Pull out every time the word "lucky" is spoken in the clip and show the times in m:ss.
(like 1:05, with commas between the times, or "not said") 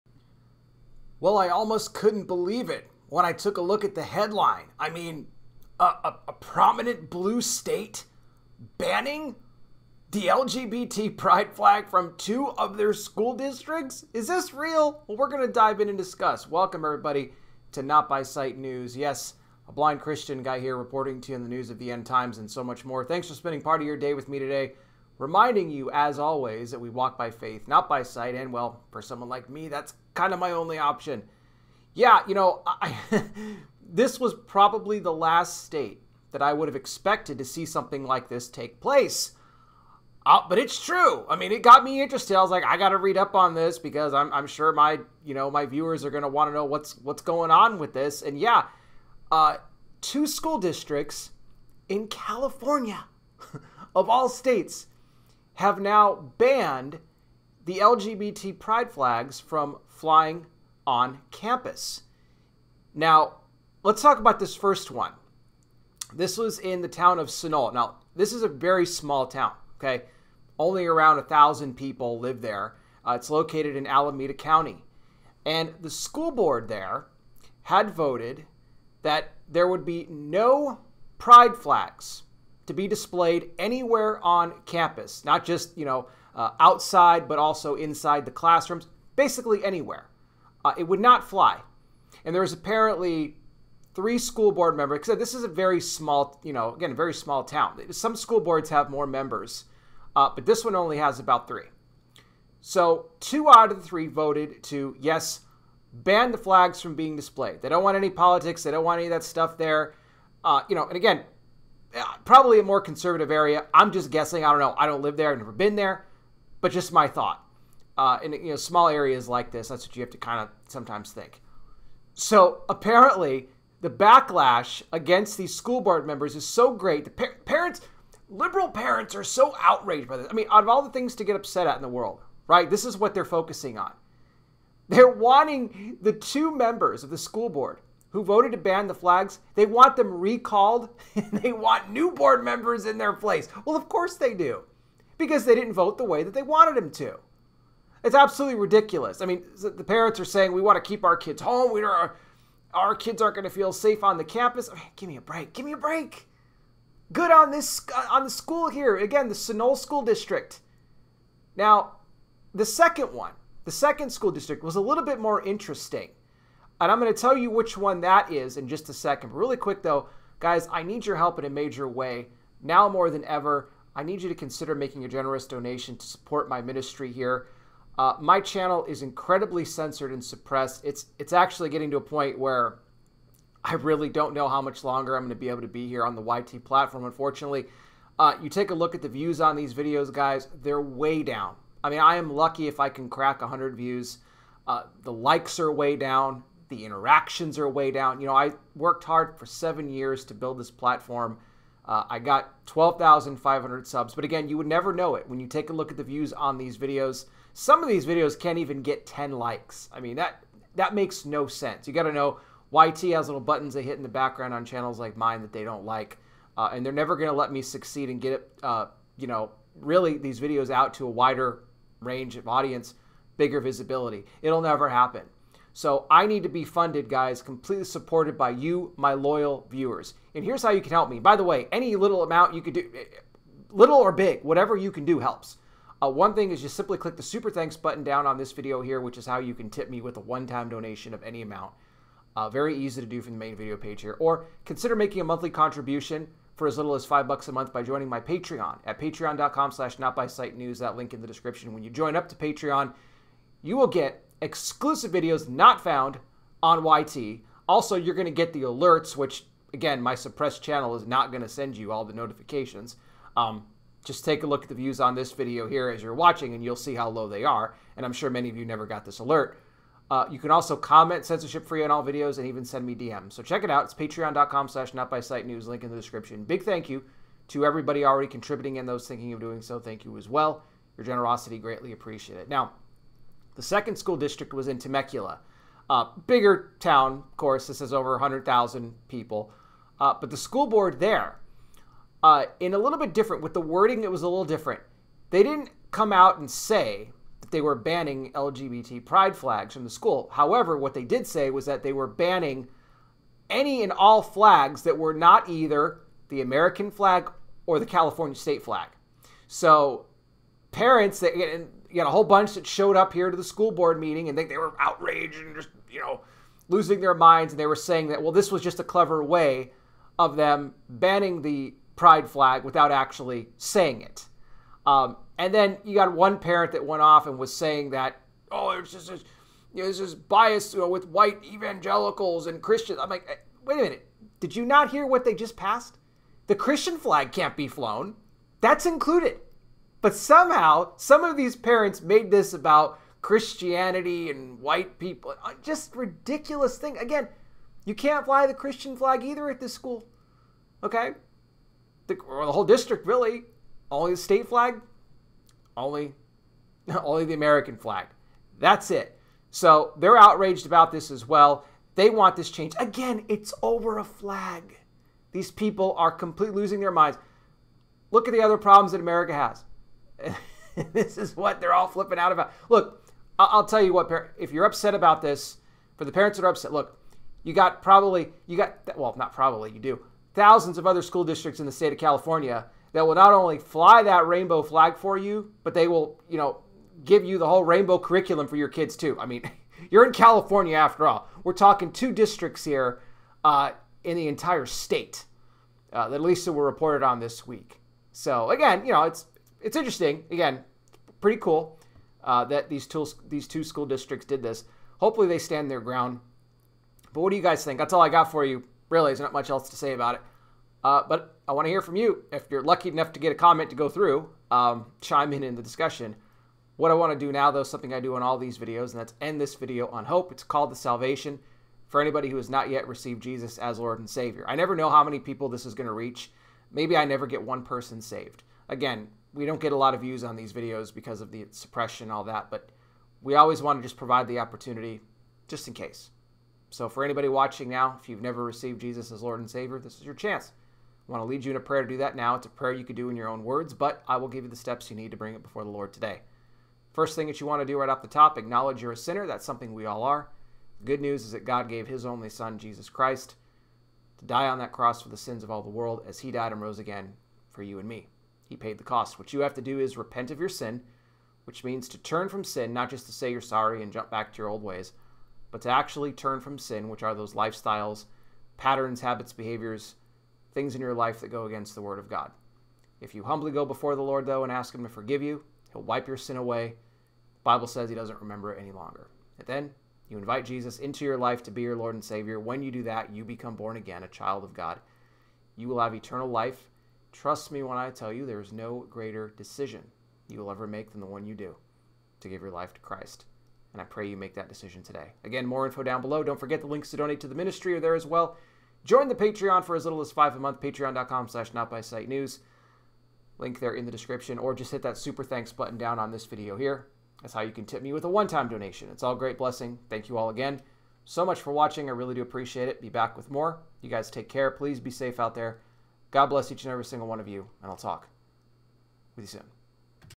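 3:12, 6:52.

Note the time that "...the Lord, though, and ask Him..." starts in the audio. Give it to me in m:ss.
7:53.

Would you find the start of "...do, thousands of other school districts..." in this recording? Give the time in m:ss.
6:19.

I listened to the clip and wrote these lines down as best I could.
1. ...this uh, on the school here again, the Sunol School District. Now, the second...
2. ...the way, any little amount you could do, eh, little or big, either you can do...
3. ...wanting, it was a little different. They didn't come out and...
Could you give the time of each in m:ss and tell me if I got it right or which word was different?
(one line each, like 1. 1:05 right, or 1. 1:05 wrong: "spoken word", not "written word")
1. 2:37 right
2. 3:51 wrong: "whatever", not "either"
3. 4:53 wrong: "wording", not "wanting".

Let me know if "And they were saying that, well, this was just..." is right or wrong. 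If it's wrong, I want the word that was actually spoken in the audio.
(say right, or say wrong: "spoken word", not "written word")
right.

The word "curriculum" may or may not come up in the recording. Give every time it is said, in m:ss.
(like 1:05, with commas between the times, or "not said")
6:27.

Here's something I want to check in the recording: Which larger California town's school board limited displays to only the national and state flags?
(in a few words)
Temecula.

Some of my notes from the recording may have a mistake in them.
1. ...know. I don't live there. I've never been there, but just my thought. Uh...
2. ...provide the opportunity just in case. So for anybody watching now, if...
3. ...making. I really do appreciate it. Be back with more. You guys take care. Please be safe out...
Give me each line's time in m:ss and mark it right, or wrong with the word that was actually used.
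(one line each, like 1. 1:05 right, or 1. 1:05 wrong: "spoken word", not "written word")
1. 1:54 right
2. 7:13 right
3. 8:31 wrong: "watching", not "making".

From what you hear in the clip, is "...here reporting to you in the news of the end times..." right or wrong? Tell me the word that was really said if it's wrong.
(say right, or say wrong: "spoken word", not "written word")
right.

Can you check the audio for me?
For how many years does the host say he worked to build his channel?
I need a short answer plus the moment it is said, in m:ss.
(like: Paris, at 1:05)
7, at 3:19.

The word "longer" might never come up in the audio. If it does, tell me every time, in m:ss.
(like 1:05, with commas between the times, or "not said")
3:04, 7:58.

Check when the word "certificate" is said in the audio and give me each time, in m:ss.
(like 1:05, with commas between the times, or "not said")
not said.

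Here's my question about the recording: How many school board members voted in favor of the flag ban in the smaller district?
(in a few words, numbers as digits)
2.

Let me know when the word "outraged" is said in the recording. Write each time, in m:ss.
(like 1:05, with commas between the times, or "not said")
2:09, 5:14, 6:00.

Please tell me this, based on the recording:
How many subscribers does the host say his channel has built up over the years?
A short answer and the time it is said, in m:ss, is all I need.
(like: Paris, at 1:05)
12,500, at 3:22.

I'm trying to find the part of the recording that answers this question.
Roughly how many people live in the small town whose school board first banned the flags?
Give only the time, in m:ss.
1:11.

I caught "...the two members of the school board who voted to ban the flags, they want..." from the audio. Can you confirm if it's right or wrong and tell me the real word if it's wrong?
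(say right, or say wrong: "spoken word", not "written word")
right.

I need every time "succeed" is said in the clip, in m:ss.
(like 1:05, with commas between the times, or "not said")
3:37.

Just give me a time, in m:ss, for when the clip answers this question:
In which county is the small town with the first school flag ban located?
1:13.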